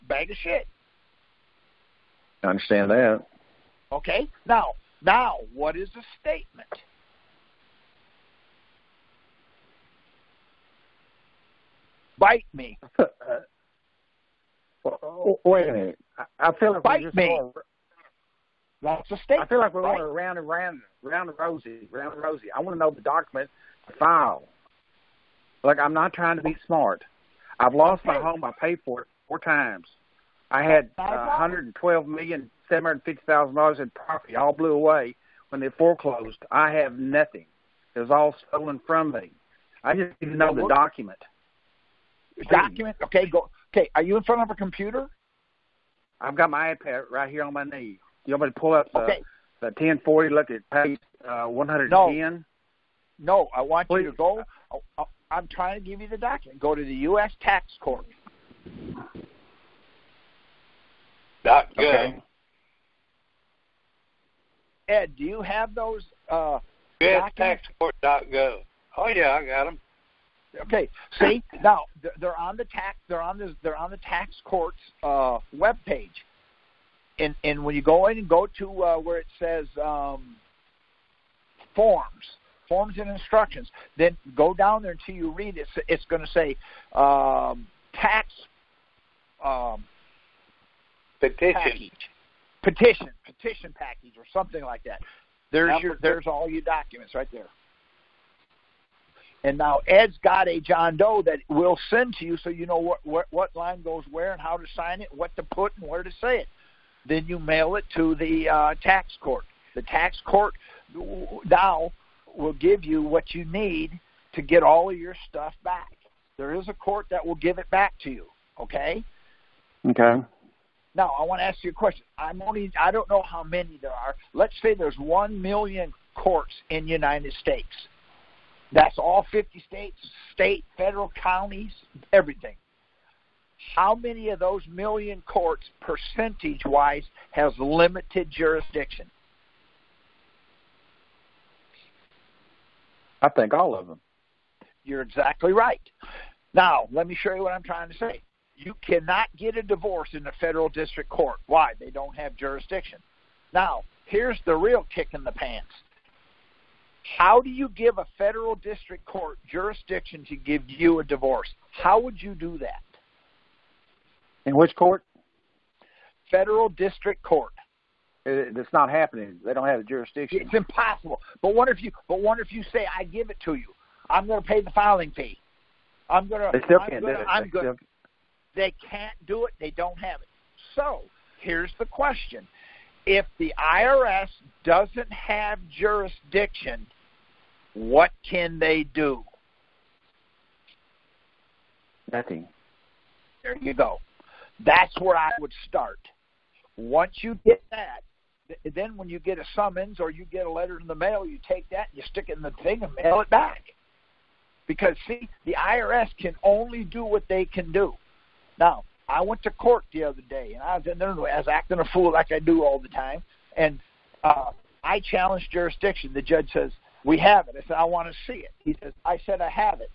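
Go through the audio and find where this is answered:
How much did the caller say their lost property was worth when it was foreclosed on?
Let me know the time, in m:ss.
0:31.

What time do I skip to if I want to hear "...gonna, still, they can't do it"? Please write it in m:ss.
2:57.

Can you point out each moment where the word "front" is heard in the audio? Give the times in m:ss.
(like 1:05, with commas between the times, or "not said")
0:44.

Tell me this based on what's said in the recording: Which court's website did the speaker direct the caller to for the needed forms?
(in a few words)
U.S. Tax Court.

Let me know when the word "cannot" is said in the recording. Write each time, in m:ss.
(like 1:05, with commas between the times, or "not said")
2:28.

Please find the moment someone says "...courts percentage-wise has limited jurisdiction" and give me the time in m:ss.
2:15.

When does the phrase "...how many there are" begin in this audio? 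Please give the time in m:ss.
2:03.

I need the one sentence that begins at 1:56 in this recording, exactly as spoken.
There is a court that will give it back to you.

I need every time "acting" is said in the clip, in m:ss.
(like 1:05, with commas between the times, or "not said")
3:31.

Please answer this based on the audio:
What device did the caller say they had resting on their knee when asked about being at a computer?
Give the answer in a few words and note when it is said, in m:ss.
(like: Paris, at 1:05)
iPad, at 0:46.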